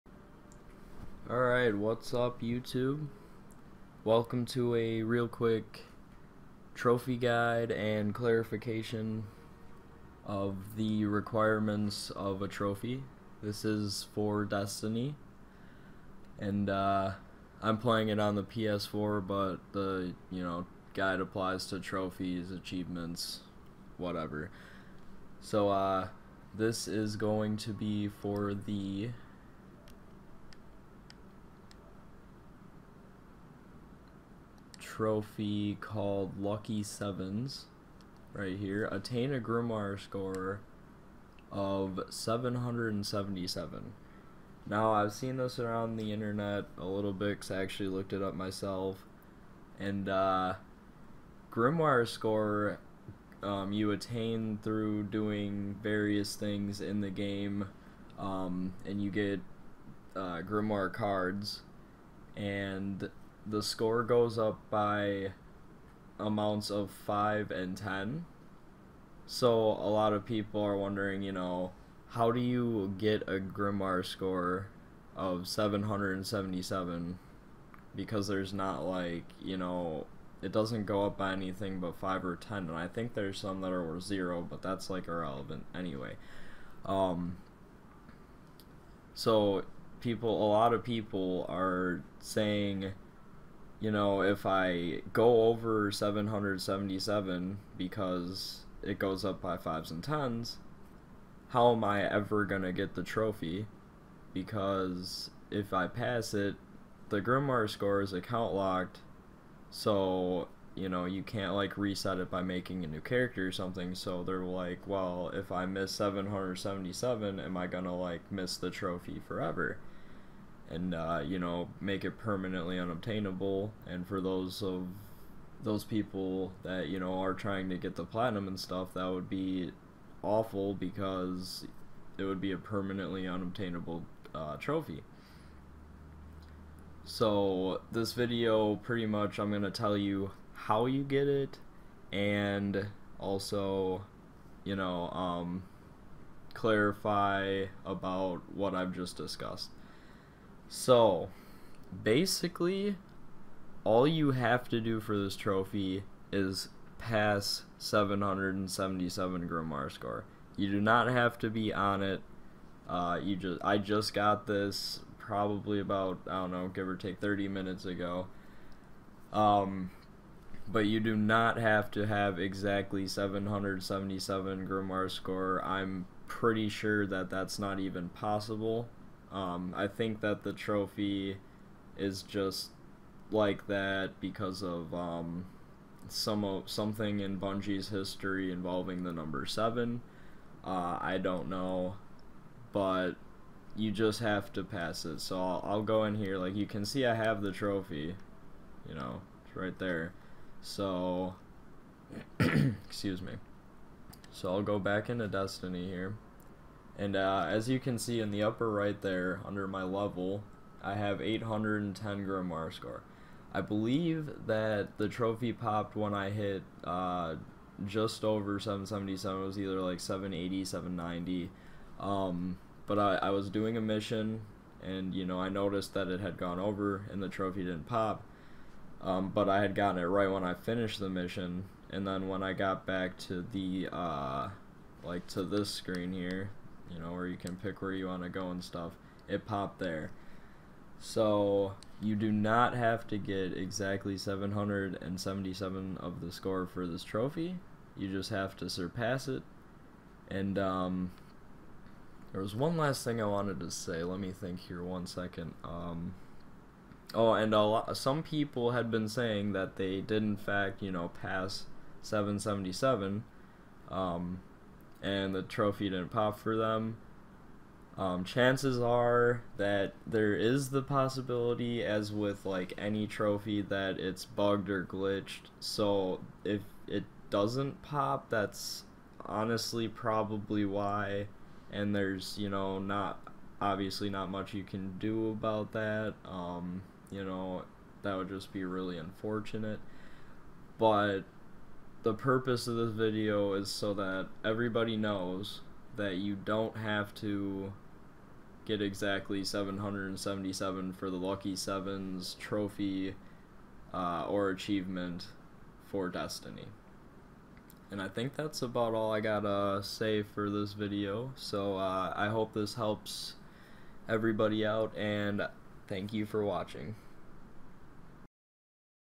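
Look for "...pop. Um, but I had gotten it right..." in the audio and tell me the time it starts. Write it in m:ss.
3:47.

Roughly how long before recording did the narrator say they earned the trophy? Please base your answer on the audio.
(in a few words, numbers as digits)
30 minutes.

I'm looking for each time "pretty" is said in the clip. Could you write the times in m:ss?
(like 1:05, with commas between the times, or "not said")
2:18, 2:56.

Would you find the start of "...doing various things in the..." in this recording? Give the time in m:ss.
0:55.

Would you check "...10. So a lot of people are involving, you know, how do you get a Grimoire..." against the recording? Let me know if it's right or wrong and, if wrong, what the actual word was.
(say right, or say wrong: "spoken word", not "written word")
wrong: "wondering", not "involving".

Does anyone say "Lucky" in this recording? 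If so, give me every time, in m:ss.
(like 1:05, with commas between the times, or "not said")
0:36, 5:01.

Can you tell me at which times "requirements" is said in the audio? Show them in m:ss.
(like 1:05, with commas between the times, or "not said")
0:11.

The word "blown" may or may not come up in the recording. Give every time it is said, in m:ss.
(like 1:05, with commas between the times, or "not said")
not said.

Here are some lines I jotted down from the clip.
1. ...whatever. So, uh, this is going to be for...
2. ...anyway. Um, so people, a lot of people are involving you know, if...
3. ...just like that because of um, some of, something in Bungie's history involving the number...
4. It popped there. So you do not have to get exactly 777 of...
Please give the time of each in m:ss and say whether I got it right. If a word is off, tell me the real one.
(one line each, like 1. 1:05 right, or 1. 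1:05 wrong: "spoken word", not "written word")
1. 0:23 right
2. 1:25 wrong: "saying", not "involving"
3. 3:02 right
4. 3:59 right.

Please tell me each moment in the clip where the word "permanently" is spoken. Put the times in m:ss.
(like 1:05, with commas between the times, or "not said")
2:02, 2:12.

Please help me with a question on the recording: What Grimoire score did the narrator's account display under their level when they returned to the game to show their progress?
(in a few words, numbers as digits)
810.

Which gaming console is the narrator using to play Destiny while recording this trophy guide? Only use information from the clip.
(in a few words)
PS4.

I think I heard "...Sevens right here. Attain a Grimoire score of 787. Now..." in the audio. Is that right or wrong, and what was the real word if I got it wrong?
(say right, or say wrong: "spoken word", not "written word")
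wrong: "777", not "787".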